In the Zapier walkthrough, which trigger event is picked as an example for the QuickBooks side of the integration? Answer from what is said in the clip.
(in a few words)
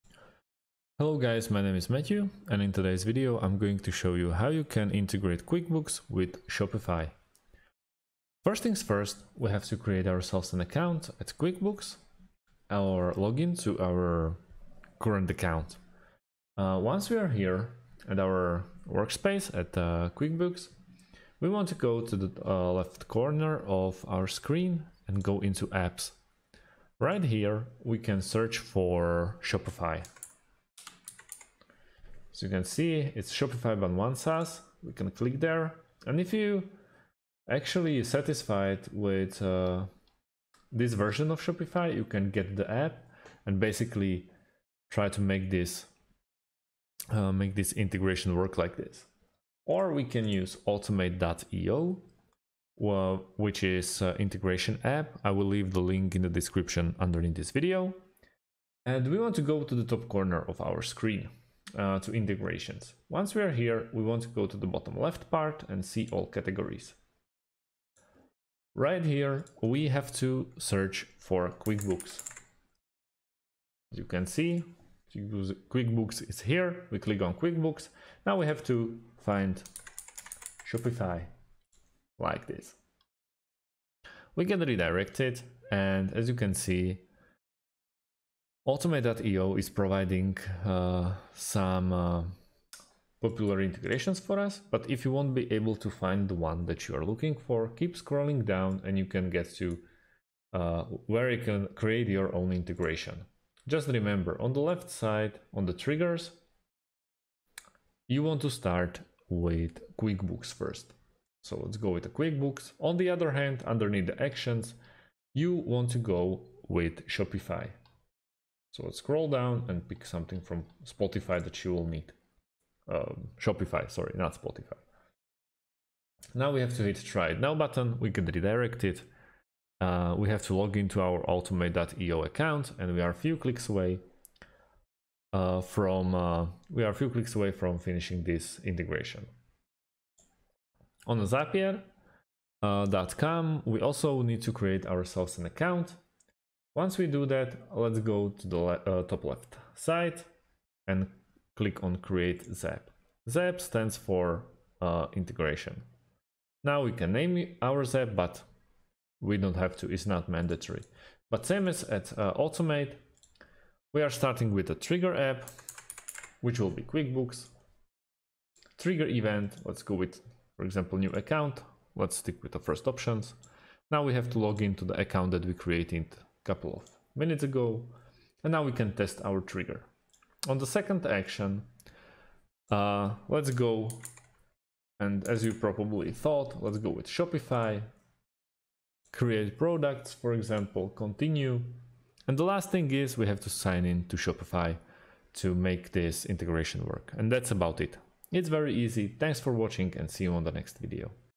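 New account.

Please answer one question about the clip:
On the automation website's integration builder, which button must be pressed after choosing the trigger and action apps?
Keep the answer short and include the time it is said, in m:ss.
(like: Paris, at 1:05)
Try it now, at 2:07.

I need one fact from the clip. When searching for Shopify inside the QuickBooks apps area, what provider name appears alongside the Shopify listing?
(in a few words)
OneSaaS.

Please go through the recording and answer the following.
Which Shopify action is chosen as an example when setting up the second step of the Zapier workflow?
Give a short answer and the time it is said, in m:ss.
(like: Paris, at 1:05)
Create products, at 3:09.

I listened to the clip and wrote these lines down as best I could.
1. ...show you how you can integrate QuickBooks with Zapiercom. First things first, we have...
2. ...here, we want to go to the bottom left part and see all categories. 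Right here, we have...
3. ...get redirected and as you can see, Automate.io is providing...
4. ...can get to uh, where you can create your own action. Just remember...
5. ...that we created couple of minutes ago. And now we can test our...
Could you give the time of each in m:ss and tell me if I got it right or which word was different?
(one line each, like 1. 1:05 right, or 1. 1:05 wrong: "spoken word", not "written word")
1. 0:03 wrong: "Shopify", not "Zapiercom"
2. 1:03 right
3. 1:24 right
4. 1:39 wrong: "integration", not "action"
5. 2:55 right.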